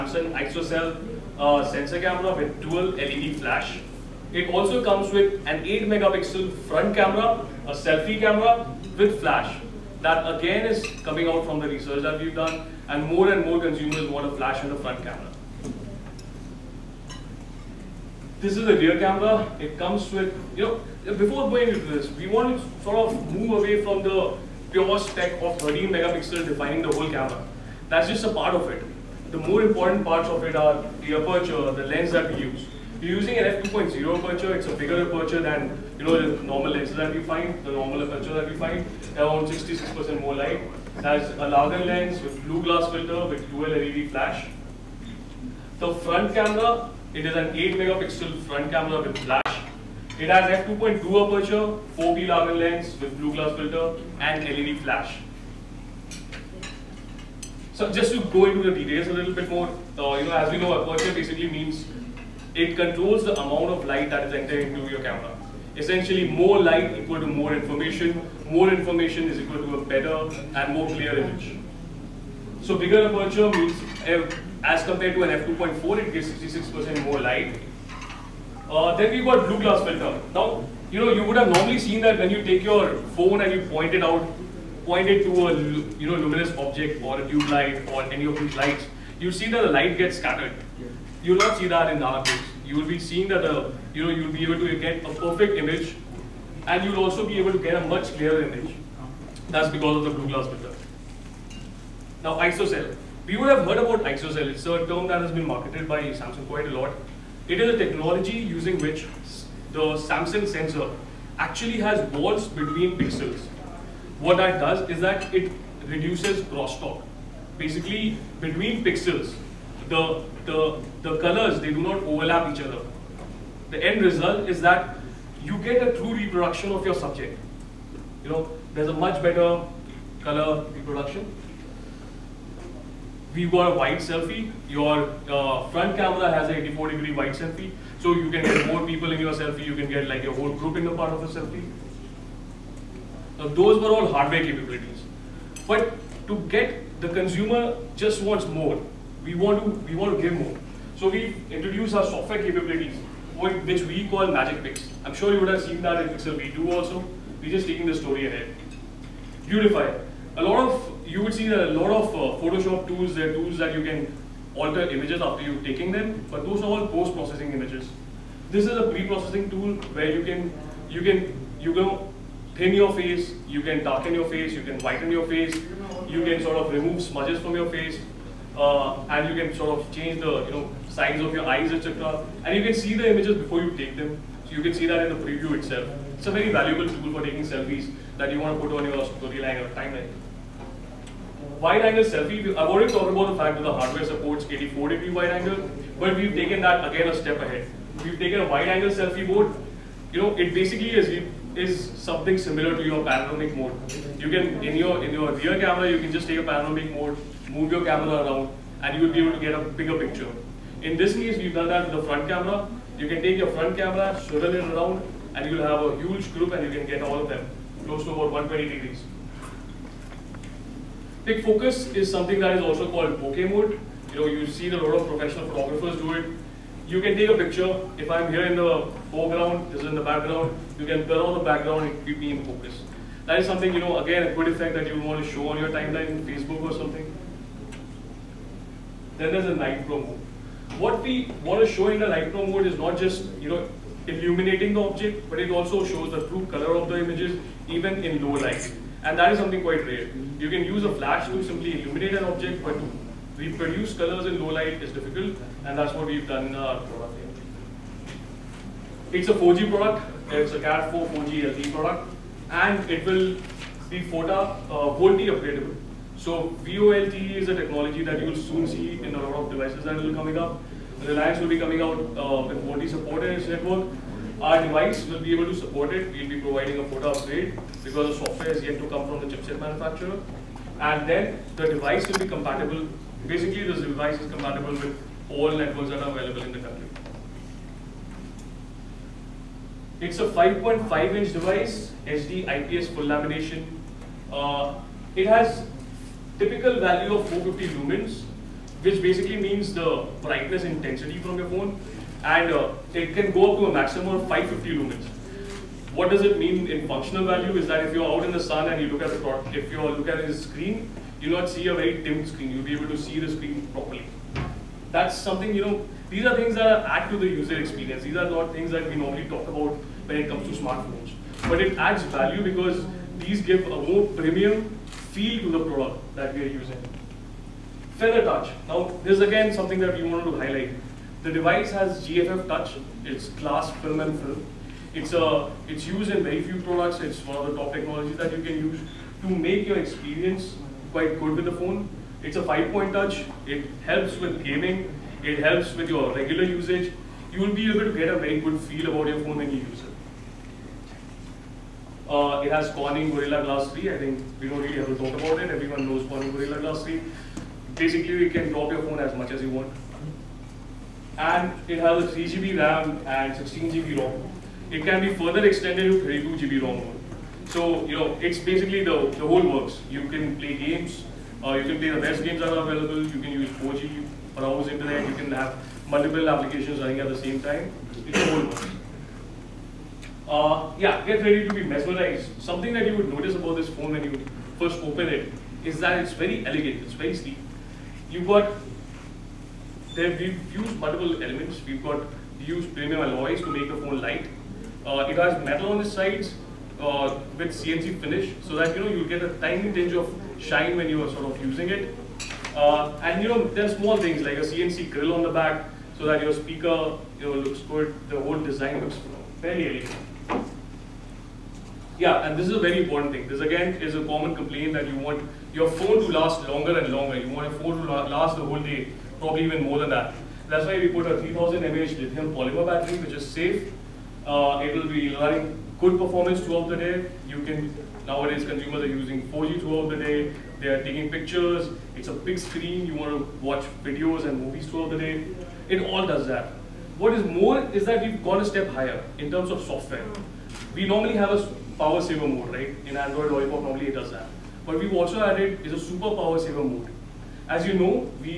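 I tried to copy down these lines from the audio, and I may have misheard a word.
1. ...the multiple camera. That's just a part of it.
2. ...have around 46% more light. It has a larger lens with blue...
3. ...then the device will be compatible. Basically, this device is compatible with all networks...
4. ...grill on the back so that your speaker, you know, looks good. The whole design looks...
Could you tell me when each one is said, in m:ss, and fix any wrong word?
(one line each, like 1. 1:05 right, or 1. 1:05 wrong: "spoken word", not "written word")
1. 0:26 wrong: "whole", not "multiple"
2. 0:39 wrong: "66", not "46"
3. 4:41 right
4. 6:44 right.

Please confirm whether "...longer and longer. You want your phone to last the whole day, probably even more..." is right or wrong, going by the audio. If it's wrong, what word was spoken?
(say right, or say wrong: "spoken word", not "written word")
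right.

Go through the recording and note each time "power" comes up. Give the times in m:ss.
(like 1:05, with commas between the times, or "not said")
7:21, 7:26.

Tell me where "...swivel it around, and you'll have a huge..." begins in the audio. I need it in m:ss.
3:34.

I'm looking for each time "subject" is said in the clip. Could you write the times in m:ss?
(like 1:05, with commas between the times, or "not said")
2:06.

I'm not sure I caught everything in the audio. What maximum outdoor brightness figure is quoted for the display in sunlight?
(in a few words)
550 lumens.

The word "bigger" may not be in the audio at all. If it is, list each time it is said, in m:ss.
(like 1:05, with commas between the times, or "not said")
0:34, 1:12, 3:29.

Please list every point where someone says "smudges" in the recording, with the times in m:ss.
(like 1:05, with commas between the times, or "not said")
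2:57.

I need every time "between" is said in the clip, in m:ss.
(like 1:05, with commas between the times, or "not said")
1:52, 1:58.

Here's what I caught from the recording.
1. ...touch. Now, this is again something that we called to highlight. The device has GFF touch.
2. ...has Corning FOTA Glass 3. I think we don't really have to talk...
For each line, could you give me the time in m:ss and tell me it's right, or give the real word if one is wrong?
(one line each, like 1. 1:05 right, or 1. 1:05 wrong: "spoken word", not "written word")
1. 5:28 wrong: "wanted", not "called"
2. 5:52 wrong: "Gorilla", not "FOTA".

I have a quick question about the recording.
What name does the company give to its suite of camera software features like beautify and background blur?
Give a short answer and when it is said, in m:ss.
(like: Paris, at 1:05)
Magic Pix, at 2:34.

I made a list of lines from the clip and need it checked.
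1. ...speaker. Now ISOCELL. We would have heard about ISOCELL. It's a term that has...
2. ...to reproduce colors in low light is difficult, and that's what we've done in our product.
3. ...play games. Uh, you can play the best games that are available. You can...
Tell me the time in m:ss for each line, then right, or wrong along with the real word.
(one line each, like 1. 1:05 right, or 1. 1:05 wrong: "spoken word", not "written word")
1. 1:40 wrong: "filter", not "speaker"
2. 4:12 right
3. 6:10 right.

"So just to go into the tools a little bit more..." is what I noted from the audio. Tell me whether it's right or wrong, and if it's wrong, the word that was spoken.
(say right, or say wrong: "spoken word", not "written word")
wrong: "details", not "tools".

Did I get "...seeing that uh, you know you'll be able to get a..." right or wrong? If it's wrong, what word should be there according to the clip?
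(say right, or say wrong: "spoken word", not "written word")
right.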